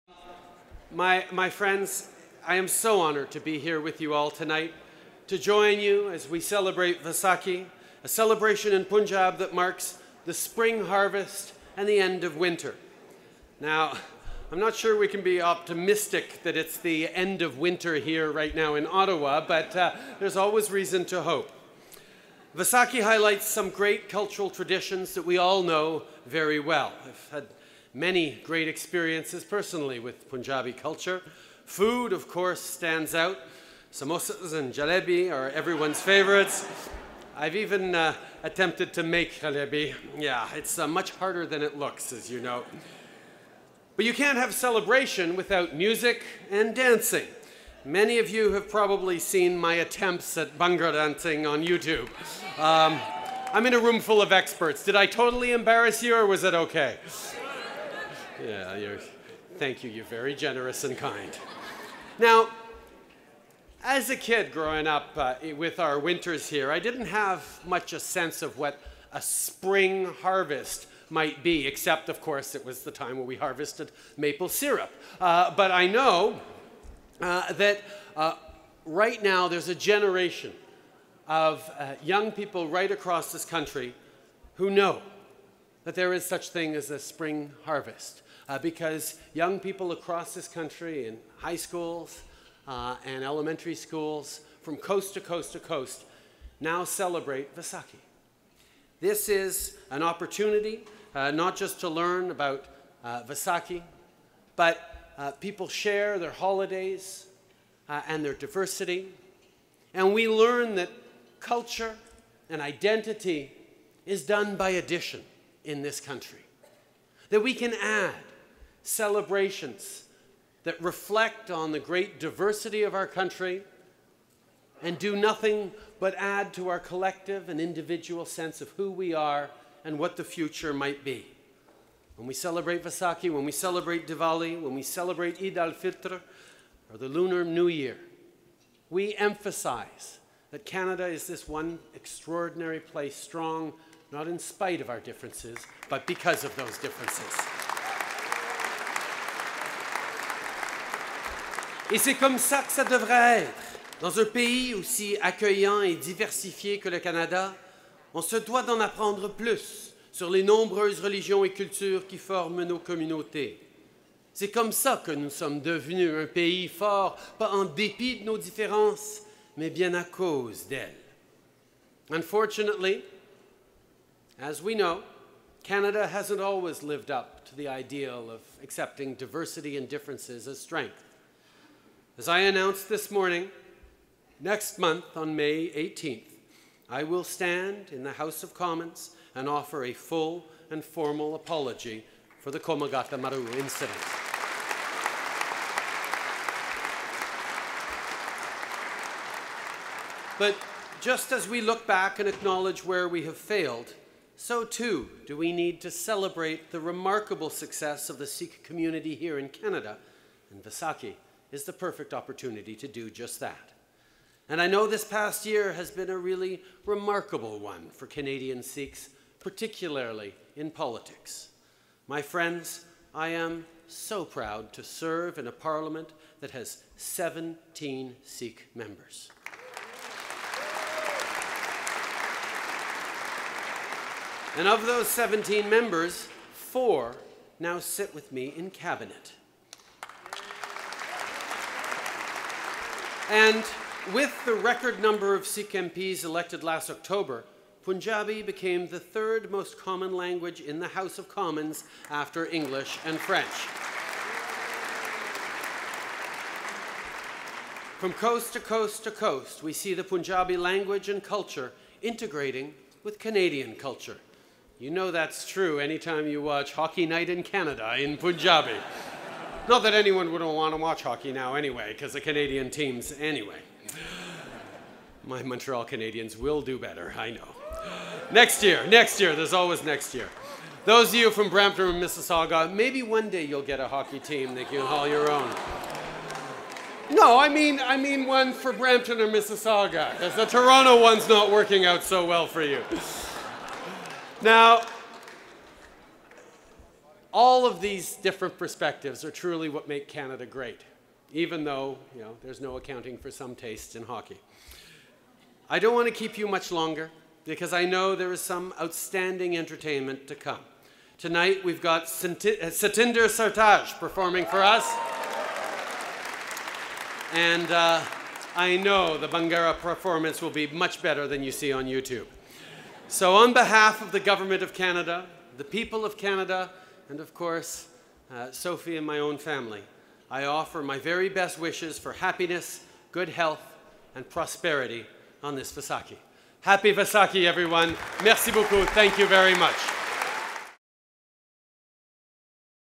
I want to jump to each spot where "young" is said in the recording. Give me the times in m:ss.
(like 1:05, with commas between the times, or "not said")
1:22, 1:29.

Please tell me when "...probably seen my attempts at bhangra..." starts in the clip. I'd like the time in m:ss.
0:48.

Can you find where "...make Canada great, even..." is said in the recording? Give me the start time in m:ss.
4:59.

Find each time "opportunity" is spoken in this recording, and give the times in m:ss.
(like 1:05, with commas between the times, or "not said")
1:40, 3:32.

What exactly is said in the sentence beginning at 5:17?
And uh, I know the bhangra performance will be much better than you see on YouTube.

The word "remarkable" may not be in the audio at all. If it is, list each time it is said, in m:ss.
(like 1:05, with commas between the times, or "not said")
3:26, 3:36.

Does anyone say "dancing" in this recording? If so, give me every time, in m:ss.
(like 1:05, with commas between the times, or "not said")
0:46, 0:50.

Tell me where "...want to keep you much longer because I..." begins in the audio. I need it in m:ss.
5:05.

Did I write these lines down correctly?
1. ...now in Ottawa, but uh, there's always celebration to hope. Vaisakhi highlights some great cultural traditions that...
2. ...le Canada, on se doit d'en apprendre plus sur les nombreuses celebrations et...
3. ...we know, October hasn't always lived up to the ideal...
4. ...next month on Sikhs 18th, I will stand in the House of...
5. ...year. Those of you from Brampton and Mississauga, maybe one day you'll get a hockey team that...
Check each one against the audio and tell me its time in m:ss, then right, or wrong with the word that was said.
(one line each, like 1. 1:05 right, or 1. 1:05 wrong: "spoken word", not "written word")
1. 0:18 wrong: "reason", not "celebration"
2. 2:36 wrong: "religions", not "celebrations"
3. 2:54 wrong: "Canada", not "October"
4. 3:04 wrong: "May", not "Sikhs"
5. 4:40 right.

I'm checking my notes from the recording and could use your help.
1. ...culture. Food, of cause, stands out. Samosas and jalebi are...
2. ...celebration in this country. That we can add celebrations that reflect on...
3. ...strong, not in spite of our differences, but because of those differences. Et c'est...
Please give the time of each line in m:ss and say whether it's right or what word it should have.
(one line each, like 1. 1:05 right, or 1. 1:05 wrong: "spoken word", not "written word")
1. 0:30 wrong: "course", not "cause"
2. 1:54 wrong: "addition", not "celebration"
3. 2:23 right.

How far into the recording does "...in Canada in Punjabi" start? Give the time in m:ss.
4:27.